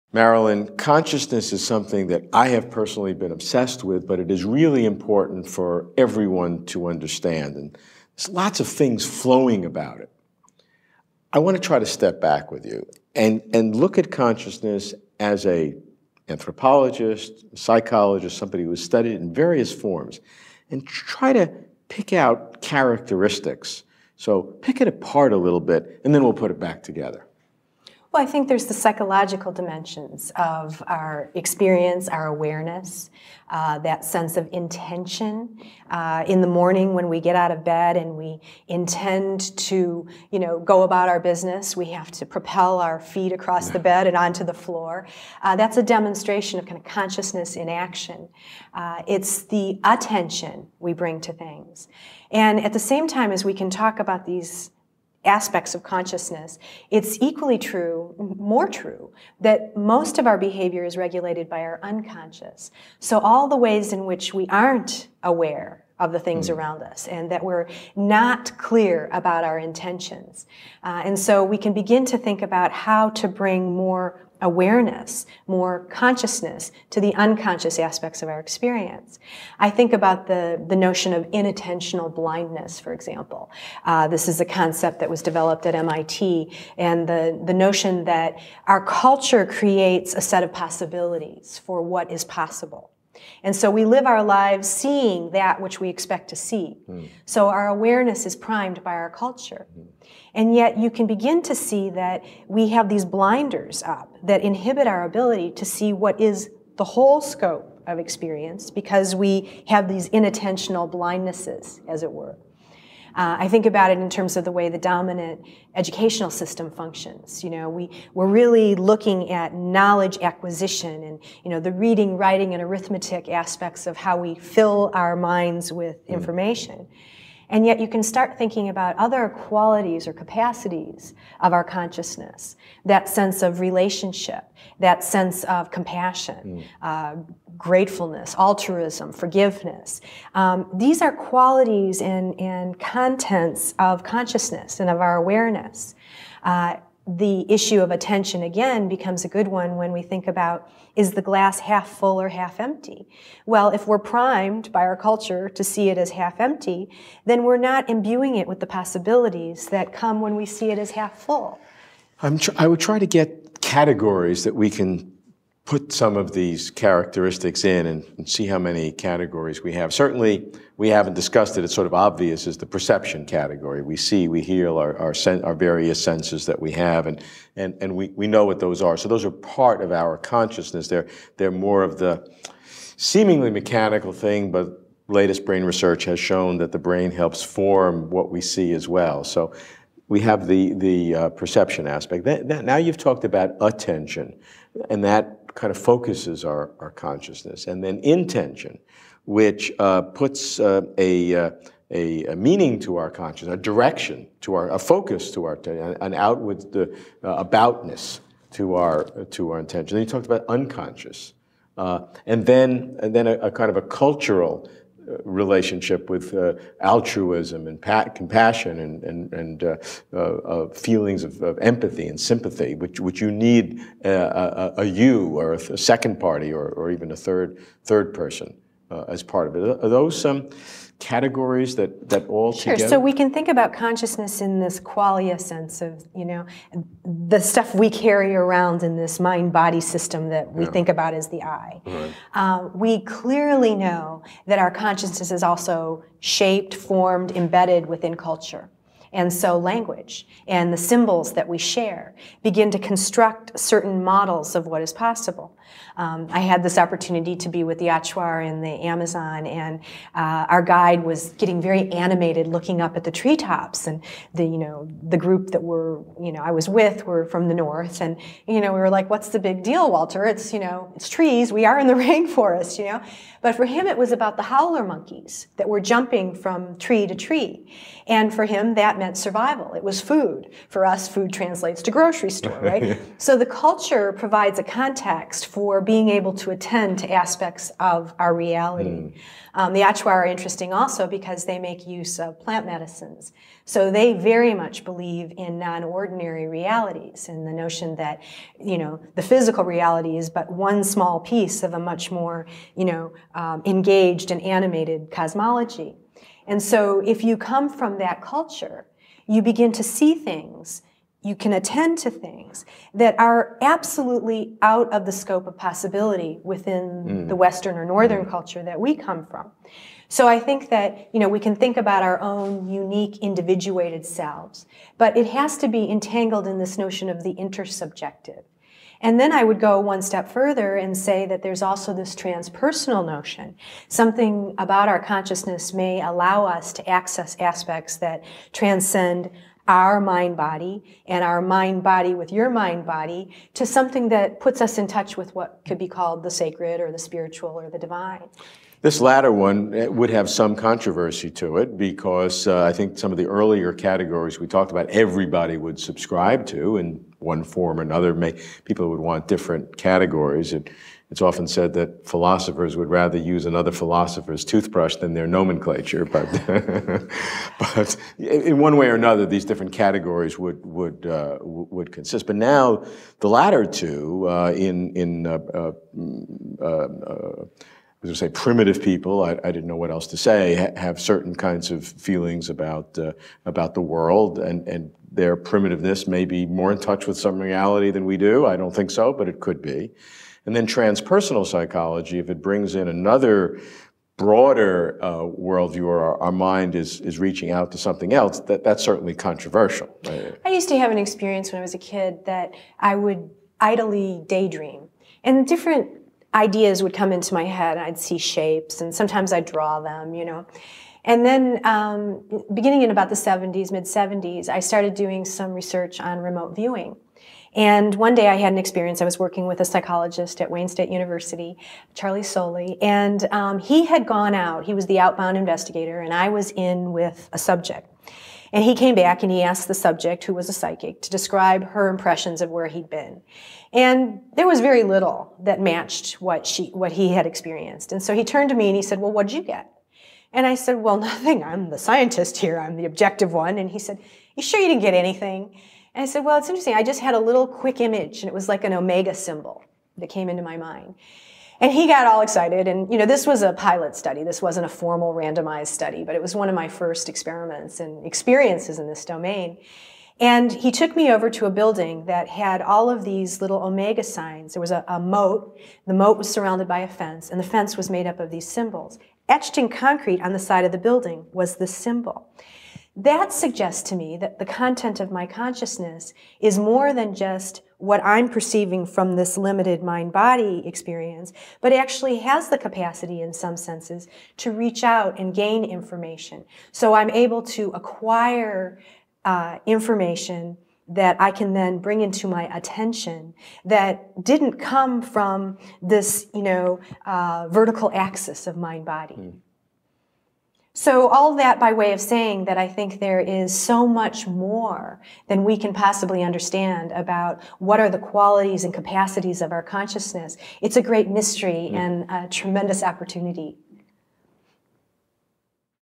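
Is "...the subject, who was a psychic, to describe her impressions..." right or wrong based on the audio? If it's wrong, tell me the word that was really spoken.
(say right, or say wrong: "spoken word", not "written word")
right.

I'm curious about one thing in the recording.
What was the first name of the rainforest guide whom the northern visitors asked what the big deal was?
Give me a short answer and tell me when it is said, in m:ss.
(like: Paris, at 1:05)
Walter, at 4:29.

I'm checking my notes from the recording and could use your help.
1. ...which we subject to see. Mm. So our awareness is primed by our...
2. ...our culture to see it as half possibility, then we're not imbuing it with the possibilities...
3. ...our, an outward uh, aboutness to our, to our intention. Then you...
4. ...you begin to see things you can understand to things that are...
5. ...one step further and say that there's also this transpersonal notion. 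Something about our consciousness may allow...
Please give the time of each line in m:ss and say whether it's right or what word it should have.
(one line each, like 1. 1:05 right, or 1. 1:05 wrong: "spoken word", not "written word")
1. 1:35 wrong: "expect", not "subject"
2. 2:34 wrong: "empty", not "possibility"
3. 3:25 right
4. 5:09 wrong: "attend", not "understand"
5. 5:29 right.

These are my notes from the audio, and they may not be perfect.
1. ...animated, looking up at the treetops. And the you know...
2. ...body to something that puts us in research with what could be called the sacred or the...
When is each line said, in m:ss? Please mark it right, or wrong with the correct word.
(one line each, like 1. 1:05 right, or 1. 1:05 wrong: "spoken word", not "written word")
1. 4:21 right
2. 5:42 wrong: "touch", not "research".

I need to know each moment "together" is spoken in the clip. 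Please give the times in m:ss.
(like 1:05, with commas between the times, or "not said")
0:26, 3:52.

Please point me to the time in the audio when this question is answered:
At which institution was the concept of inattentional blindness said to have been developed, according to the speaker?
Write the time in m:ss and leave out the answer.
1:25.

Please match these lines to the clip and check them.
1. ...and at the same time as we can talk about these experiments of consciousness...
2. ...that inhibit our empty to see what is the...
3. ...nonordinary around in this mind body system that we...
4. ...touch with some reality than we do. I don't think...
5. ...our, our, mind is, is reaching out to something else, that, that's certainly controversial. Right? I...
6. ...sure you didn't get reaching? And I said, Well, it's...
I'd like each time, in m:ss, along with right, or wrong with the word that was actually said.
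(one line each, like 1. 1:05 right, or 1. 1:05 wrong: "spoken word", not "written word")
1. 0:52 wrong: "aspects", not "experiments"
2. 1:44 wrong: "ability", not "empty"
3. 3:57 wrong: "carry", not "nonordinary"
4. 6:26 right
5. 6:35 right
6. 7:24 wrong: "anything", not "reaching".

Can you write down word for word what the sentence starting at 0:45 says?
Uh, that's a demonstration of kind of consciousness in action.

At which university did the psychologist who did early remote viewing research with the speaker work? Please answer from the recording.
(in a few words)
Wayne State University.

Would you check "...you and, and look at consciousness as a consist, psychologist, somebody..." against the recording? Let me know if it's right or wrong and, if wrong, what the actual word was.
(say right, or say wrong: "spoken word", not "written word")
wrong: "anthropologist", not "consist".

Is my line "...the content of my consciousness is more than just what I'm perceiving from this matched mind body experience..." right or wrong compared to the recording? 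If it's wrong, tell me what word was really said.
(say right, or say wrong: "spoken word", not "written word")
wrong: "limited", not "matched".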